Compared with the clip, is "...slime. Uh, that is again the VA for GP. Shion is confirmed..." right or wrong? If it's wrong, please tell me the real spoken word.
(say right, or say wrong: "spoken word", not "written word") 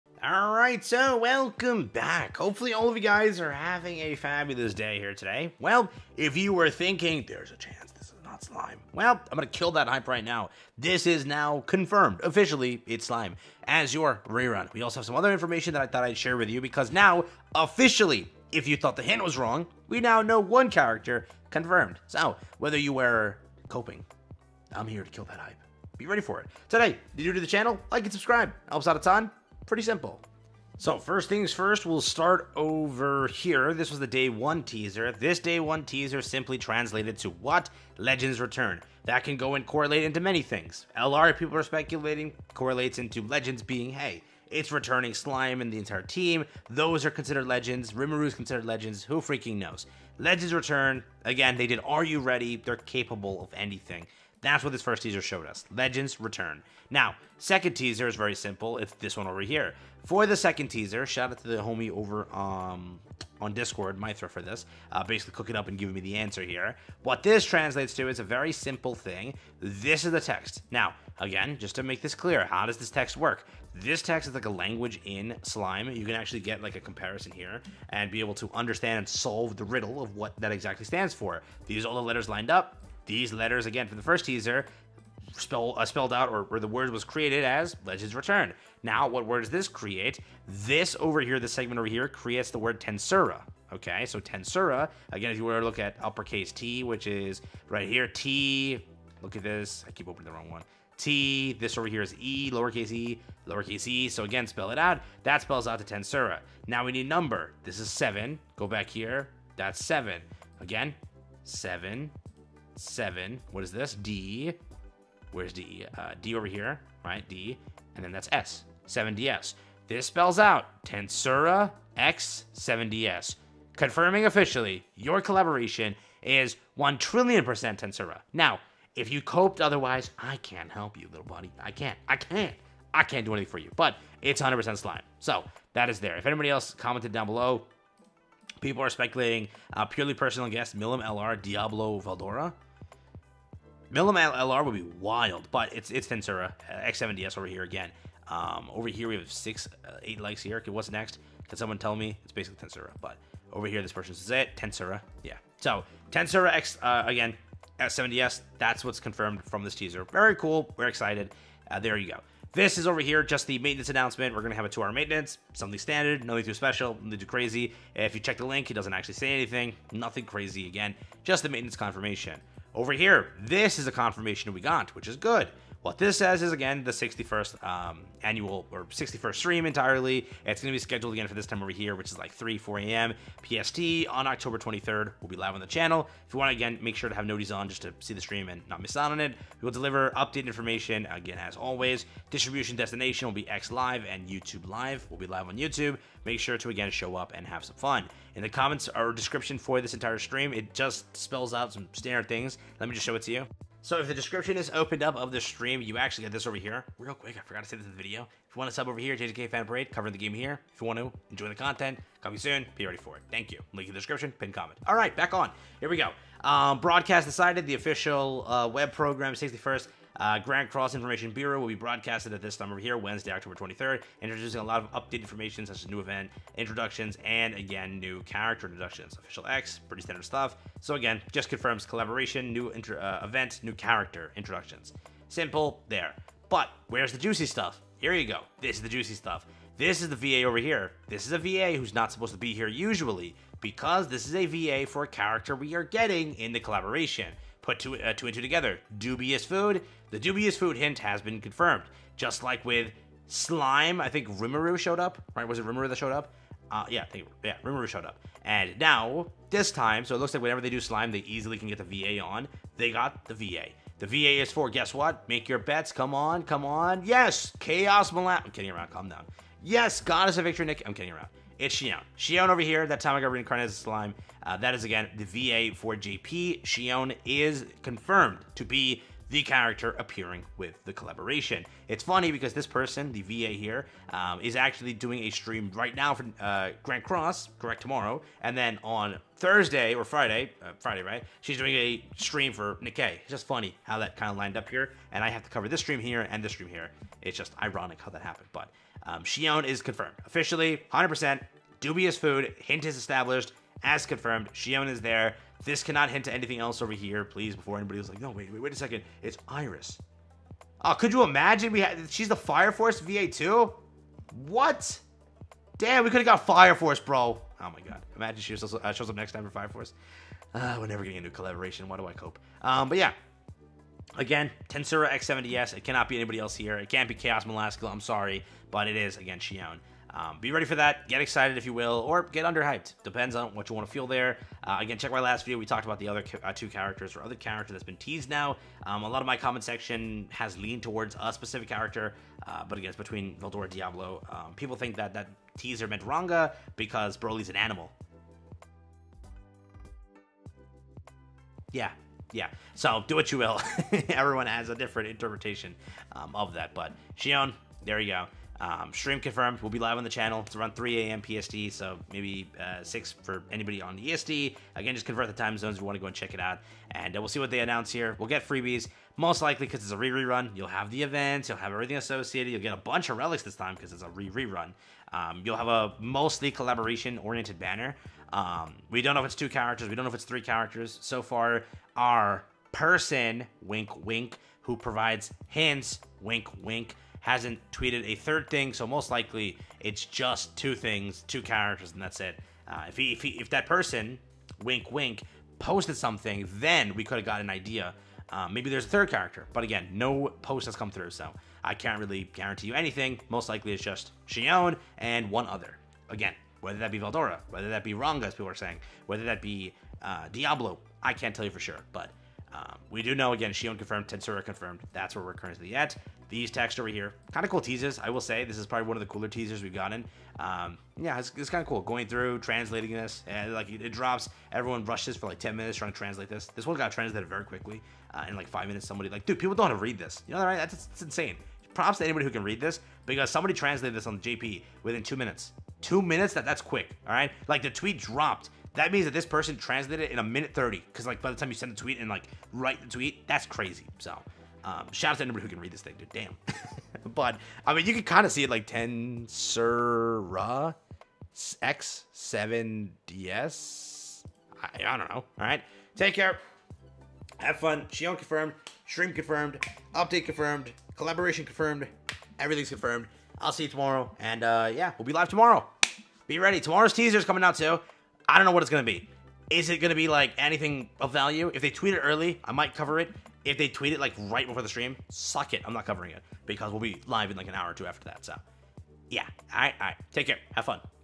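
right.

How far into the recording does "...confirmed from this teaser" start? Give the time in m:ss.
2:39.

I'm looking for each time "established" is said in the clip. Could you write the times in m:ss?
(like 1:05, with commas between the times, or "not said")
5:02.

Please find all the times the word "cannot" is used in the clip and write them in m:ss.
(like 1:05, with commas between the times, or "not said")
5:05, 5:25.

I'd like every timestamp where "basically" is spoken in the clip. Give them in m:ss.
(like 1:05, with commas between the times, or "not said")
1:05, 2:32.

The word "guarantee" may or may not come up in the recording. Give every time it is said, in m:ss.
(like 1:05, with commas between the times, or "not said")
6:42.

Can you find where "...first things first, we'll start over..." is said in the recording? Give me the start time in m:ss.
0:30.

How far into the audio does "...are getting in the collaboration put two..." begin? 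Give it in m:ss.
4:05.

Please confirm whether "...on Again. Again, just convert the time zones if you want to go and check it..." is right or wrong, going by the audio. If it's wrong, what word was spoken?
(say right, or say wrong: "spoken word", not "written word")
wrong: "EST", not "Again".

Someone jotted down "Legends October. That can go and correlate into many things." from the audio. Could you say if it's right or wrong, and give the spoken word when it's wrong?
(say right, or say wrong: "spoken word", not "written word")
wrong: "Return", not "October".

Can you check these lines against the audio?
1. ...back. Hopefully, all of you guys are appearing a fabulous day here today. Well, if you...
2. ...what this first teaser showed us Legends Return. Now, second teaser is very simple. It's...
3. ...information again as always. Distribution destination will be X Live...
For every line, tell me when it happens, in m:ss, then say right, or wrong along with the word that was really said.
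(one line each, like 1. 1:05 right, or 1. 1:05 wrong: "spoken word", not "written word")
1. 0:01 wrong: "having", not "appearing"
2. 0:54 right
3. 3:10 right.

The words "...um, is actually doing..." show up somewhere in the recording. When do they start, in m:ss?
4:44.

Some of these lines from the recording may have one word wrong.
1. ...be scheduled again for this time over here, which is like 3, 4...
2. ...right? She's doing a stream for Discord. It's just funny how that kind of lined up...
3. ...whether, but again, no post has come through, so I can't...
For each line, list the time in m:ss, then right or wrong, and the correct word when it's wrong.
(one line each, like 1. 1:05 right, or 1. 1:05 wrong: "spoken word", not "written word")
1. 3:00 right
2. 4:51 wrong: "Nikke", not "Discord"
3. 6:39 wrong: "character", not "whether".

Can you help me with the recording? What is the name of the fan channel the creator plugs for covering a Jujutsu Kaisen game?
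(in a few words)
JJK Fan Parade.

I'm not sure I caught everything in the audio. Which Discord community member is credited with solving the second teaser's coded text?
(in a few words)
Mithra.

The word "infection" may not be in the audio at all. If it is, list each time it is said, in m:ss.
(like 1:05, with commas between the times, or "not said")
not said.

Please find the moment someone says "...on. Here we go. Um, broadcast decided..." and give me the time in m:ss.
3:35.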